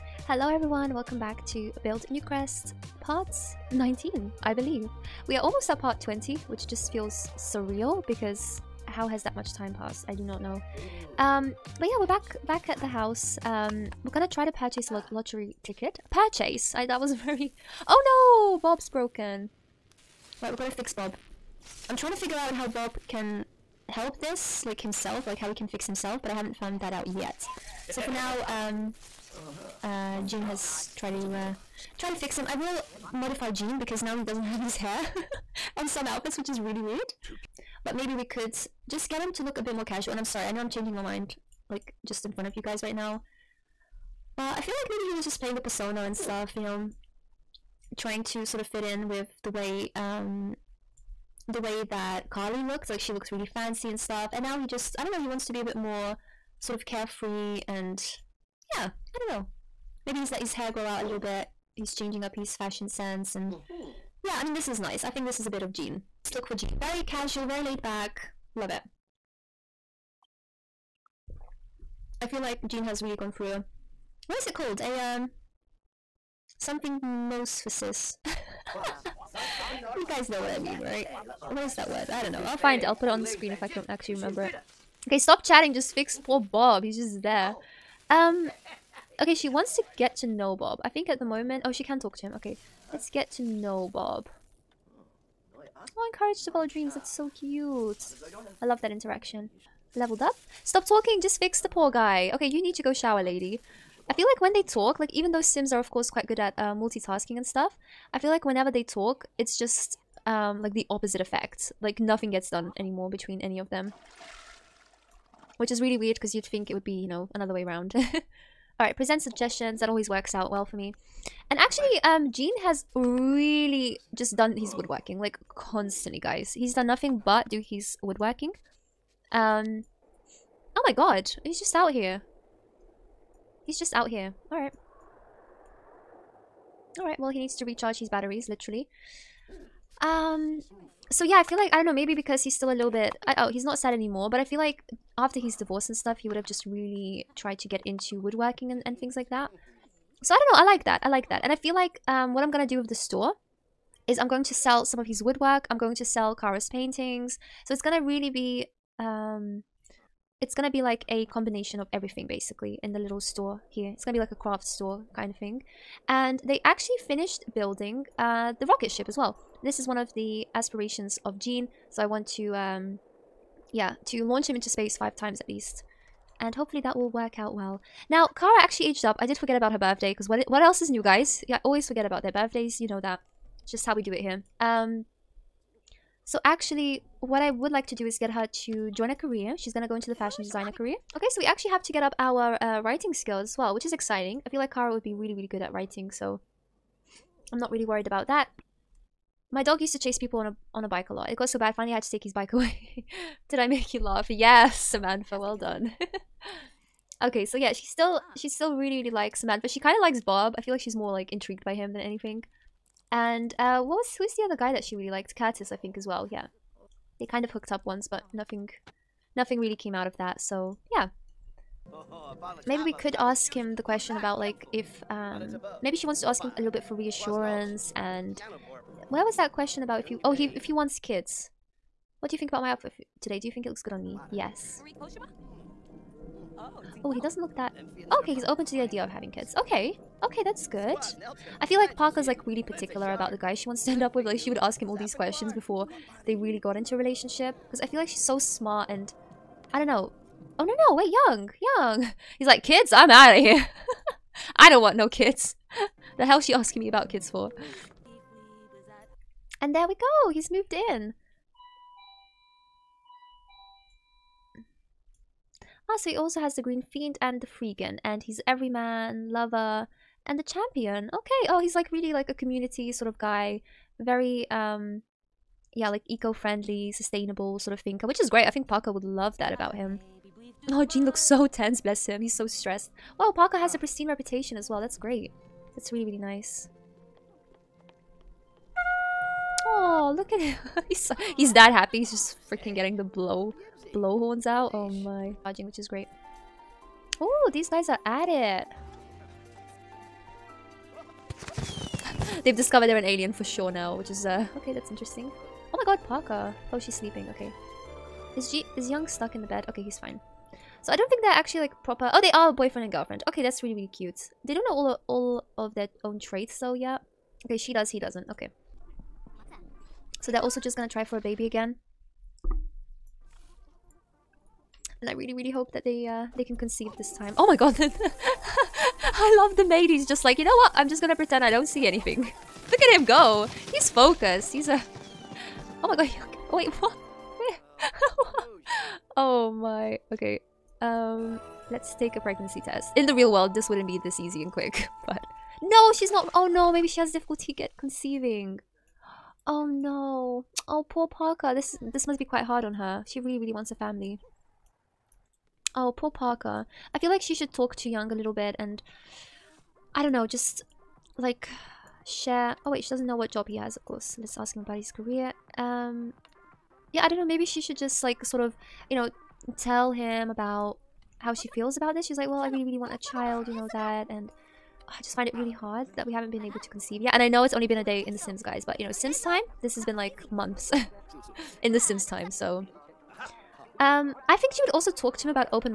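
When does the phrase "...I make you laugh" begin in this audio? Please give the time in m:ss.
3:23.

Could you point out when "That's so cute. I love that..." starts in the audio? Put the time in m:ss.
1:36.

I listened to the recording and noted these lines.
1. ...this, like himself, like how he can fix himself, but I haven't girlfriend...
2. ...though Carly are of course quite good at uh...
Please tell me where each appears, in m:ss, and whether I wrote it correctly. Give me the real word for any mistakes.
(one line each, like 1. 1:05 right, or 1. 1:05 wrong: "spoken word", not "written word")
1. 0:24 wrong: "found", not "girlfriend"
2. 1:45 wrong: "Sims", not "Carly".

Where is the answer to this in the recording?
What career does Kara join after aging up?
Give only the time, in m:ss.
3:10.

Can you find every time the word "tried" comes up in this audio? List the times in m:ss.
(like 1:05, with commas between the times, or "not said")
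0:30, 2:27.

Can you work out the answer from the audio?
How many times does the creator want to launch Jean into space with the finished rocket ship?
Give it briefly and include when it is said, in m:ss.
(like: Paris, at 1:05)
5, at 2:54.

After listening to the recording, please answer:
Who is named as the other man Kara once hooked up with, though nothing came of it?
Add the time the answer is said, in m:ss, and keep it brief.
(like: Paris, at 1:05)
Curtis, at 3:35.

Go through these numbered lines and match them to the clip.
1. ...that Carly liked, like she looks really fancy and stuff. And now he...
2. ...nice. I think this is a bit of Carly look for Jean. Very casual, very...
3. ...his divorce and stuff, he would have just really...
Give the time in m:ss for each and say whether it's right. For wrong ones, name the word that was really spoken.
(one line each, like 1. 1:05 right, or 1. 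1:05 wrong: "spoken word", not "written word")
1. 0:51 wrong: "looked", not "liked"
2. 1:04 wrong: "Jean", not "Carly"
3. 2:25 right.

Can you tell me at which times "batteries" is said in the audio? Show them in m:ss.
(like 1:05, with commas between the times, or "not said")
2:18.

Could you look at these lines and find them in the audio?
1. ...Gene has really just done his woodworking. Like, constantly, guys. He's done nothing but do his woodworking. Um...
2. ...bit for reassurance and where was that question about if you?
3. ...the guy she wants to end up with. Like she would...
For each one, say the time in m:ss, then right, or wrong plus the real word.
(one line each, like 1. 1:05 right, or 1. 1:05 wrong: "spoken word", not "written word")
1. 2:02 right
2. 3:46 right
3. 4:03 right.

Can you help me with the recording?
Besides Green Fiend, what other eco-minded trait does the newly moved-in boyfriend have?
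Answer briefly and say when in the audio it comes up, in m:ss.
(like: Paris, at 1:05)
Freegan, at 4:27.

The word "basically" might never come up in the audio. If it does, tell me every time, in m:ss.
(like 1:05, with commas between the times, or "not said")
2:42.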